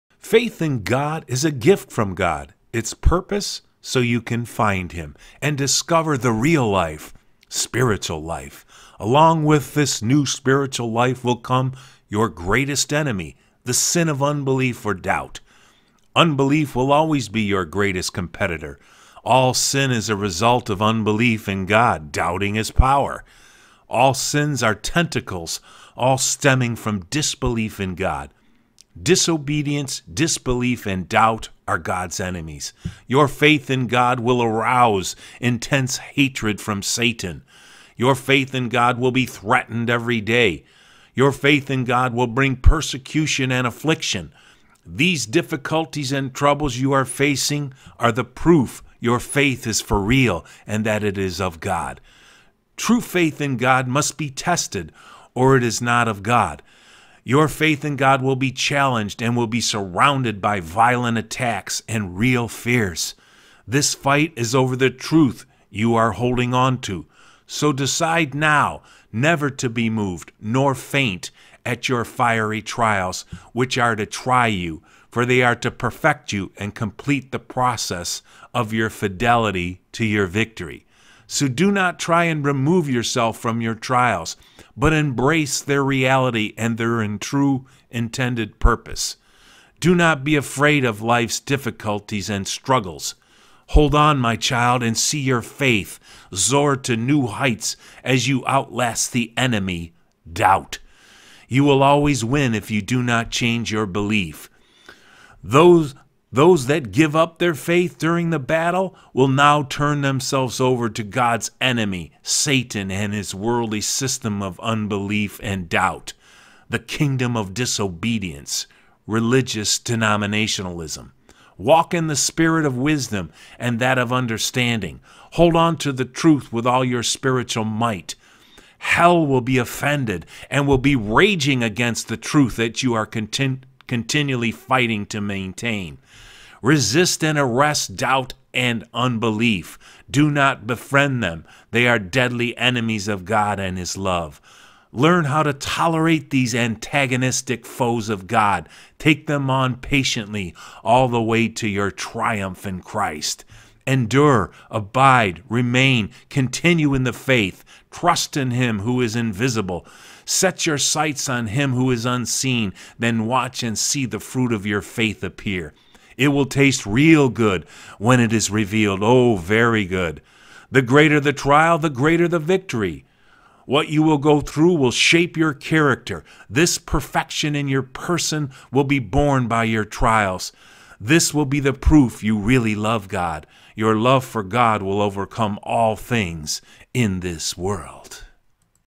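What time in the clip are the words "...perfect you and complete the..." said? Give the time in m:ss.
1:15.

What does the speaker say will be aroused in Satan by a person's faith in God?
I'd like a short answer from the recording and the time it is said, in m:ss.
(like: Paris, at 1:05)
Intense hatred, at 0:35.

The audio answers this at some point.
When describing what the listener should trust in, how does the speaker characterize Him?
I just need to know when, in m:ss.
2:39.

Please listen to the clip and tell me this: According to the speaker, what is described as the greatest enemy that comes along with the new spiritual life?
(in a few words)
The sin of unbelief.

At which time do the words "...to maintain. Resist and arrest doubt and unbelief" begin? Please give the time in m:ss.
2:15.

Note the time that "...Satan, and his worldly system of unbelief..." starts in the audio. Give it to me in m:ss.
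1:52.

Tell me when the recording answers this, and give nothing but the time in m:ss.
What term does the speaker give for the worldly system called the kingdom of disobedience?
1:59.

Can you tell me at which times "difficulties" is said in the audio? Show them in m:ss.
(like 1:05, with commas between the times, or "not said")
0:45, 1:31.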